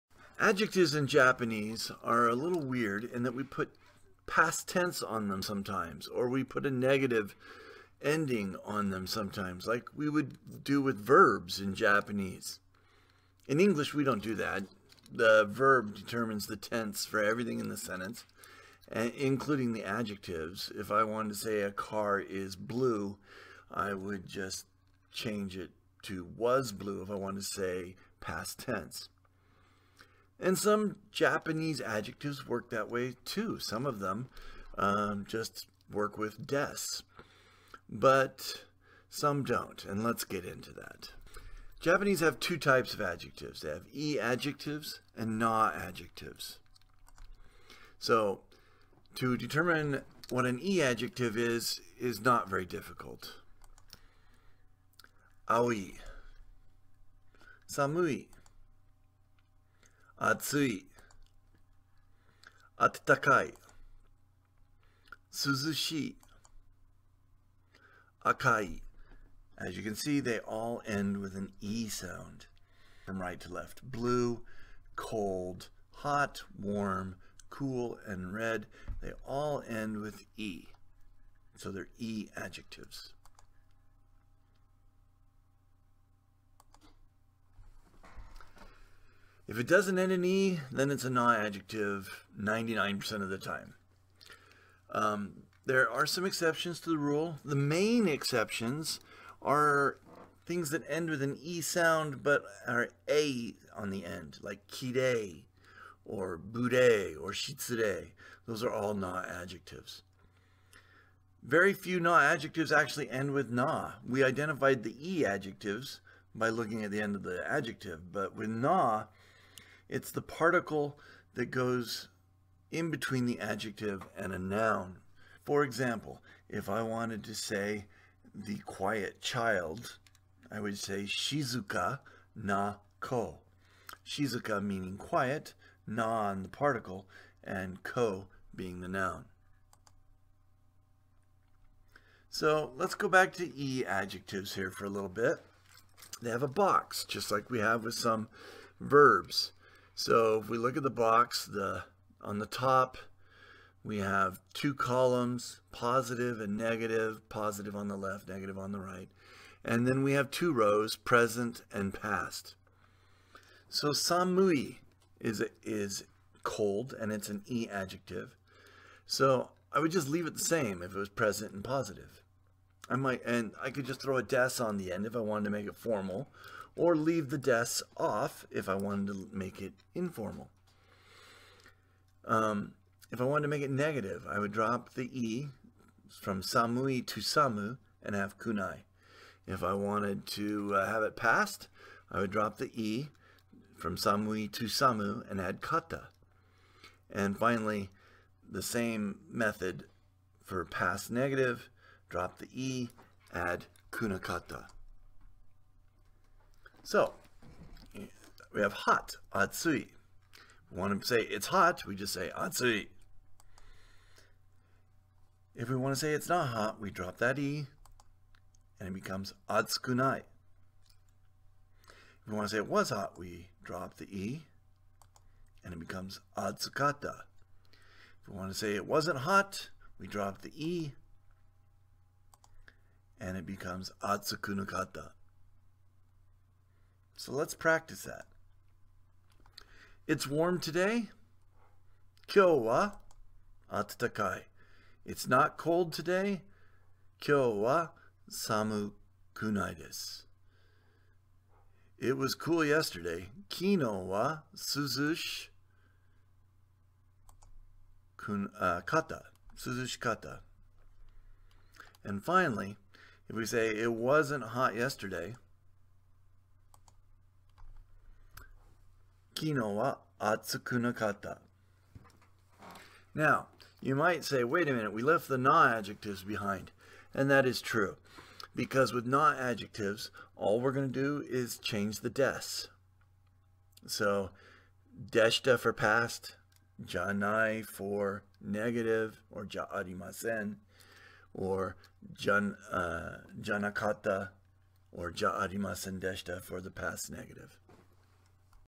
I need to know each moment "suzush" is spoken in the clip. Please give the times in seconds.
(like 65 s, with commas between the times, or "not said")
254 s, 259 s.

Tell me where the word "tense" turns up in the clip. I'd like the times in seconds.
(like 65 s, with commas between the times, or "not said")
4 s, 16 s, 28 s.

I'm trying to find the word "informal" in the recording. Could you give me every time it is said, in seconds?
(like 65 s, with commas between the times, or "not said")
179 s.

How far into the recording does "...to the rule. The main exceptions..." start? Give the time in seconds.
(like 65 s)
96 s.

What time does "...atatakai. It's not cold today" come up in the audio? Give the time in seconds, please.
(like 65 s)
243 s.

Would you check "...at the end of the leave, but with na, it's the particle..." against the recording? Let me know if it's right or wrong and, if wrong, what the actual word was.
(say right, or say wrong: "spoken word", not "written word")
wrong: "adjective", not "leave".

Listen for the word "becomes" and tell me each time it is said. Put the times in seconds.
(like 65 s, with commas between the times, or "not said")
218 s, 225 s, 233 s.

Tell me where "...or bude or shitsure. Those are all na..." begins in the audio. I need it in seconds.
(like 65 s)
106 s.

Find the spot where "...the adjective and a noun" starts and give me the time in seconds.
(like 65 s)
123 s.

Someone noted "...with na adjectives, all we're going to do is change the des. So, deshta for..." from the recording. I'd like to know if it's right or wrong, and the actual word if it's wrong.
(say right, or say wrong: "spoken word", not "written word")
right.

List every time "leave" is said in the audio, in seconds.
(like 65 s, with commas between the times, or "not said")
170 s, 176 s.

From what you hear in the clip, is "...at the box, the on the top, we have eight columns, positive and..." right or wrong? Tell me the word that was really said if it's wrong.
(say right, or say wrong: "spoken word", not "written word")
wrong: "two", not "eight".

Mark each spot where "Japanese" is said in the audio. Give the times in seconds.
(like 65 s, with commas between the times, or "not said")
1 s, 11 s, 31 s, 41 s.